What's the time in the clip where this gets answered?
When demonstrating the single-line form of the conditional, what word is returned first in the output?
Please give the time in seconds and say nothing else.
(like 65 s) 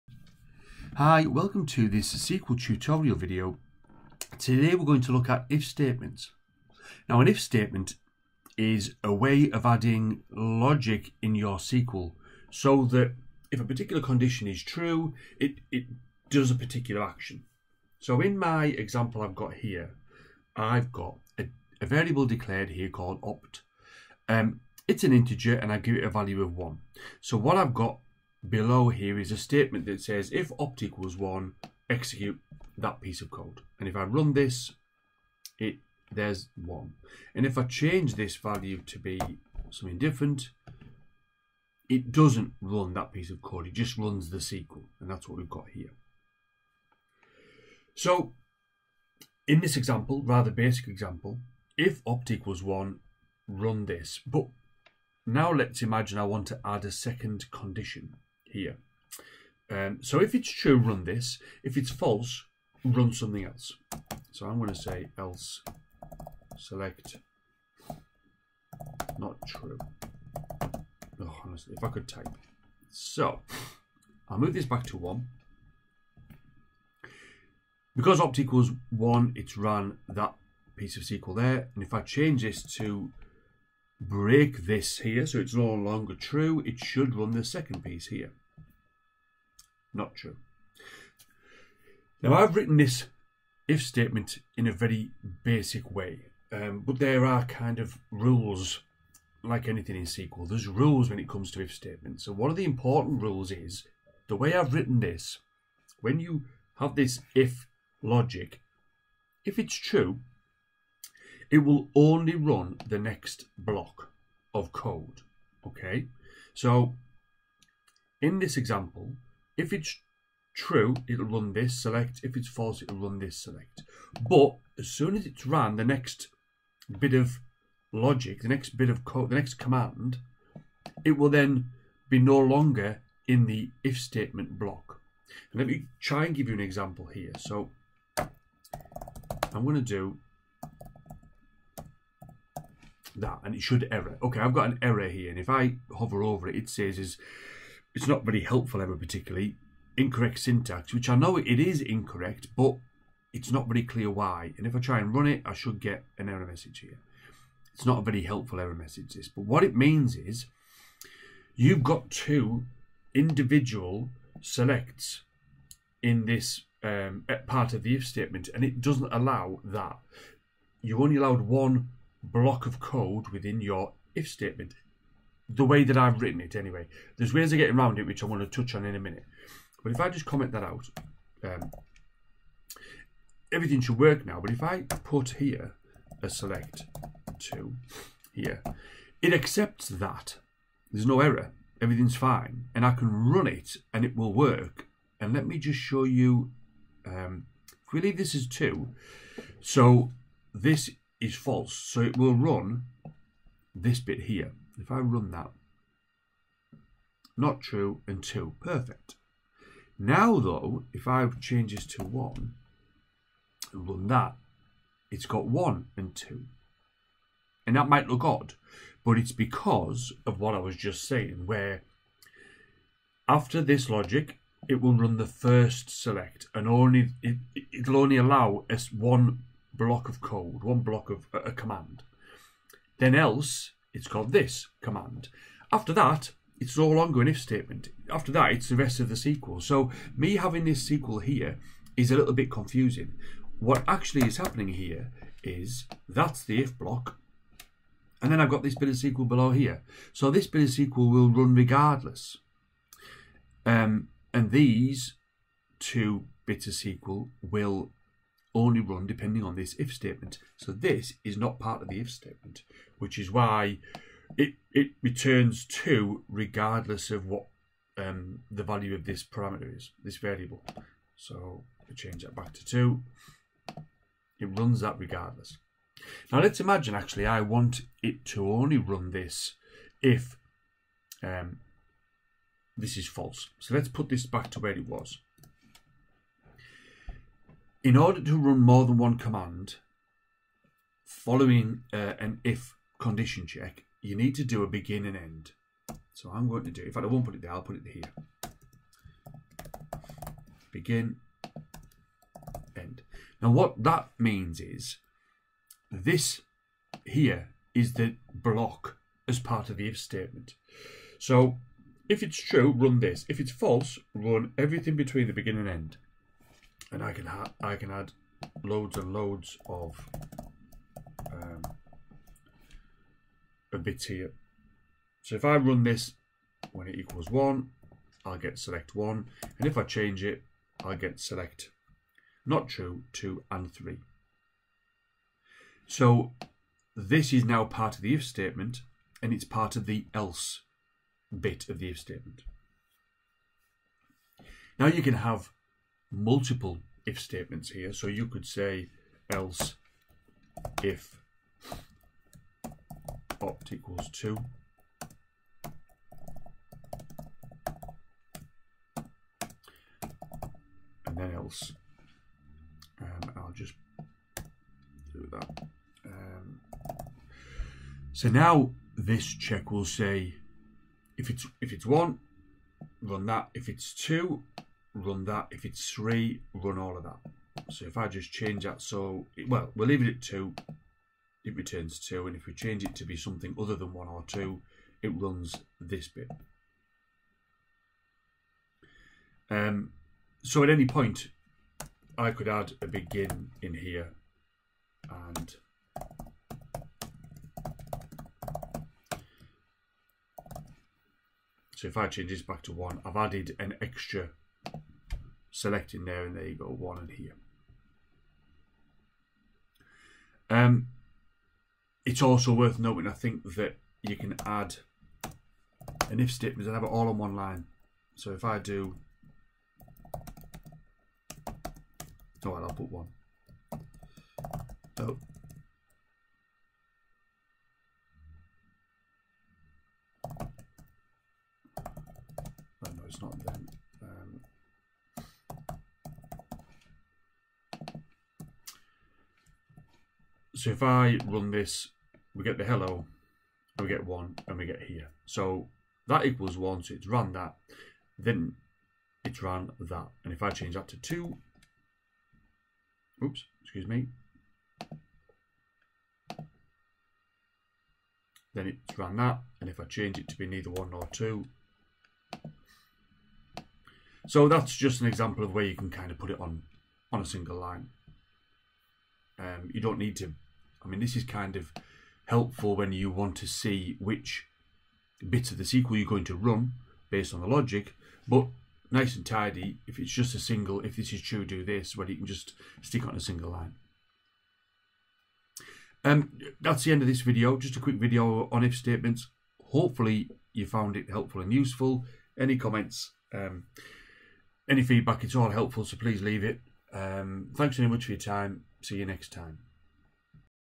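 442 s.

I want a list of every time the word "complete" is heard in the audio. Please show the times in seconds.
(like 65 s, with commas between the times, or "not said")
not said.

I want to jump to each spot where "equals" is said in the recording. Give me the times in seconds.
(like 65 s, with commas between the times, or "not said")
30 s, 52 s, 78 s, 326 s, 353 s, 446 s.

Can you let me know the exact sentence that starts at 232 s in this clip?
Then else, it's called this command.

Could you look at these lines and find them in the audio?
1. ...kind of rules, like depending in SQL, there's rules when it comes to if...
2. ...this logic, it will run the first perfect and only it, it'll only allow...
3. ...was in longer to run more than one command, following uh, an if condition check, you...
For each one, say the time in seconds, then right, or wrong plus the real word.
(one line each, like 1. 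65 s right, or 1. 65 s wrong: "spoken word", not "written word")
1. 97 s wrong: "anything", not "depending"
2. 223 s wrong: "select", not "perfect"
3. 284 s wrong: "order", not "longer".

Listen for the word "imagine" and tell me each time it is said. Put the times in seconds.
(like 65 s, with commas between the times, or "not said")
55 s, 276 s.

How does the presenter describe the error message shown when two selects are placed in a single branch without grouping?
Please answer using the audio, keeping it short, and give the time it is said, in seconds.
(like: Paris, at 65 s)
incorrect syntax, at 149 s.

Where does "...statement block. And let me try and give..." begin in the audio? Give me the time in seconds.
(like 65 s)
133 s.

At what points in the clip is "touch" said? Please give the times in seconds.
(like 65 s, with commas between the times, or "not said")
178 s.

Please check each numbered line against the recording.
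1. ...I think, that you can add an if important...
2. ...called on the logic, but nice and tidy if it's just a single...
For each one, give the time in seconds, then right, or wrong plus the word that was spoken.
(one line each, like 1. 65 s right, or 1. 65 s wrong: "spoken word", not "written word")
1. 413 s wrong: "statement", not "important"
2. 477 s wrong: "based", not "called".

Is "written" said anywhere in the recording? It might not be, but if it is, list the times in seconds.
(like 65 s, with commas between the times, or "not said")
92 s, 104 s, 176 s.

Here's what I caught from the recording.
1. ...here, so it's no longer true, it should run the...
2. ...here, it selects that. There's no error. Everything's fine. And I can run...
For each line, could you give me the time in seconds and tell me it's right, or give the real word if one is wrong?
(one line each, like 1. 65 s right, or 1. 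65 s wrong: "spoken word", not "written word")
1. 84 s right
2. 188 s wrong: "accepts", not "selects".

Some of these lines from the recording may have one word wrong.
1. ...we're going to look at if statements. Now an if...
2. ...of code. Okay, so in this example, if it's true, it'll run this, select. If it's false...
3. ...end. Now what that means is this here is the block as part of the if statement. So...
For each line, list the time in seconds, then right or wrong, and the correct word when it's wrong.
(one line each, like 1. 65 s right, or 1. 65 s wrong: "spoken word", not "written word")
1. 4 s right
2. 114 s right
3. 302 s right.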